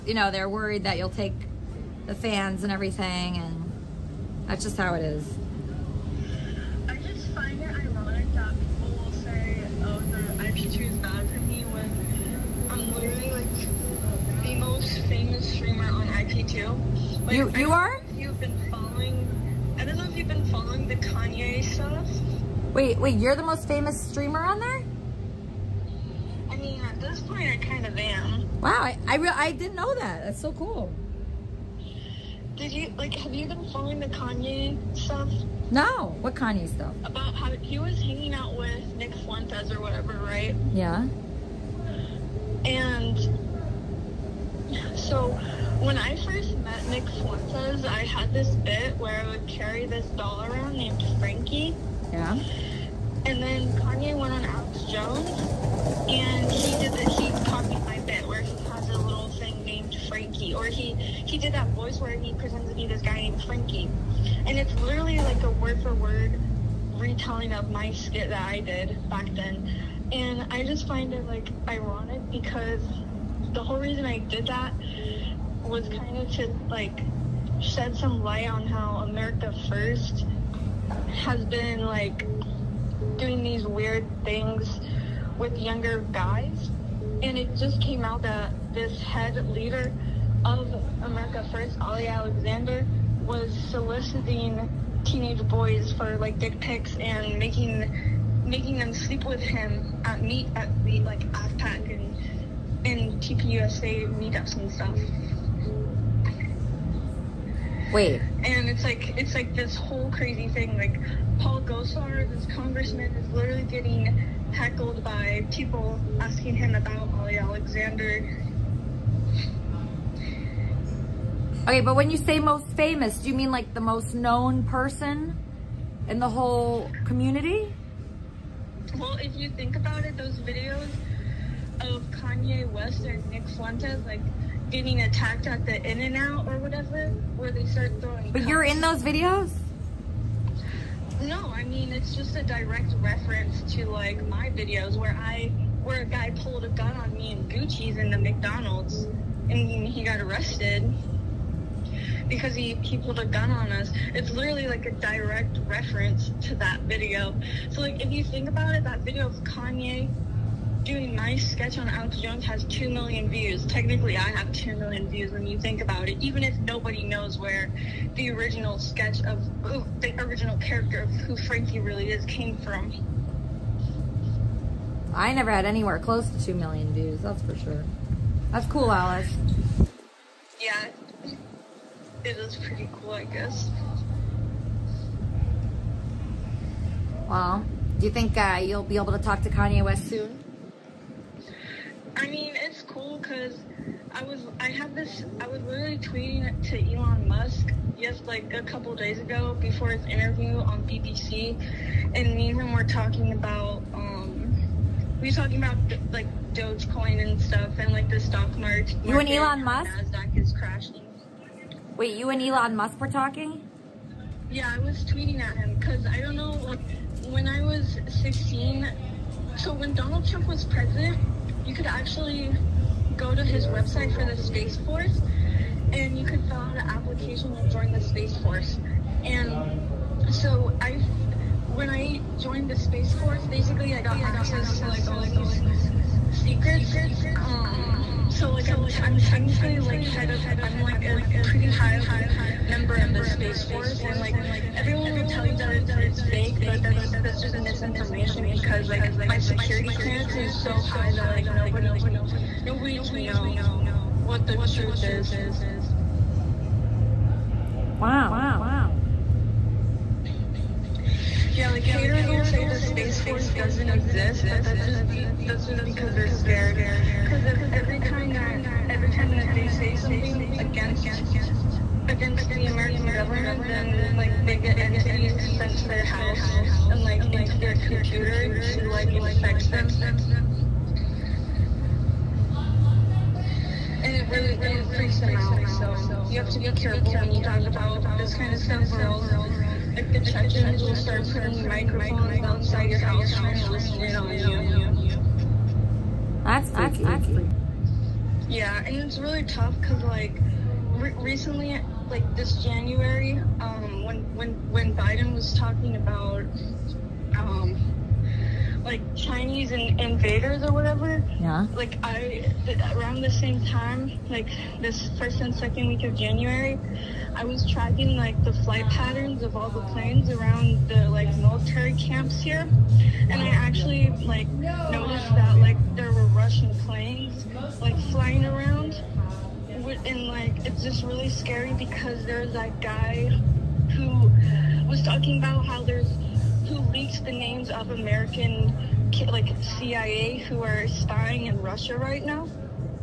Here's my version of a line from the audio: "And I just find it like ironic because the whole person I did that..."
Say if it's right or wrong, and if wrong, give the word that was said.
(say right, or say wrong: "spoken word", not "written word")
wrong: "reason", not "person".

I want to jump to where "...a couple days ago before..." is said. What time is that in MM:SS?
03:18.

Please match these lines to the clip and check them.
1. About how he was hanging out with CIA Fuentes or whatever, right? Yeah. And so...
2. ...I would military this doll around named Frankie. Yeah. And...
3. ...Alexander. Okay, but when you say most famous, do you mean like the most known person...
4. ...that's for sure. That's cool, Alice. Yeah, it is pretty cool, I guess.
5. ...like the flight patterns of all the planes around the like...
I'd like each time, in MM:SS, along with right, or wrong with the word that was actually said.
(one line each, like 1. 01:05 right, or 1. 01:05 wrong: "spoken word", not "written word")
1. 00:37 wrong: "Nick", not "CIA"
2. 00:49 wrong: "carry", not "military"
3. 01:57 right
4. 02:57 right
5. 05:18 right.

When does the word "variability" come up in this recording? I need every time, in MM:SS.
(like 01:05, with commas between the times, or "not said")
not said.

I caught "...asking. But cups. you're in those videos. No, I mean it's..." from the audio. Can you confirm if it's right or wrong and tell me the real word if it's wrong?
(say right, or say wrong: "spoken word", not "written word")
wrong: "throwing", not "asking".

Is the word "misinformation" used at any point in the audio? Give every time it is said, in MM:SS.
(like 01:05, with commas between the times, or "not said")
04:07.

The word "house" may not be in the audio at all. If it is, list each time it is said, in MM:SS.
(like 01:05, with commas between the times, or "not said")
04:36, 04:52.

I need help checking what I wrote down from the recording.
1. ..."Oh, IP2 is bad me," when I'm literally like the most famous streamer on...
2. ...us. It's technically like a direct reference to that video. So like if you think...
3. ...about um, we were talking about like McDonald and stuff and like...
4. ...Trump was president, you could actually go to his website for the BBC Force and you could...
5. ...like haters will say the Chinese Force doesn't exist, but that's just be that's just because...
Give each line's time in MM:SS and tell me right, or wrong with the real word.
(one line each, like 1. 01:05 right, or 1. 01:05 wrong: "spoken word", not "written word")
1. 00:09 right
2. 02:33 wrong: "literally", not "technically"
3. 03:23 wrong: "Dogecoin", not "McDonald"
4. 03:40 wrong: "Space", not "BBC"
5. 04:21 wrong: "Space", not "Chinese".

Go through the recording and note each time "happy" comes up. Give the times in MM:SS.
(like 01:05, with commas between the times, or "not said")
not said.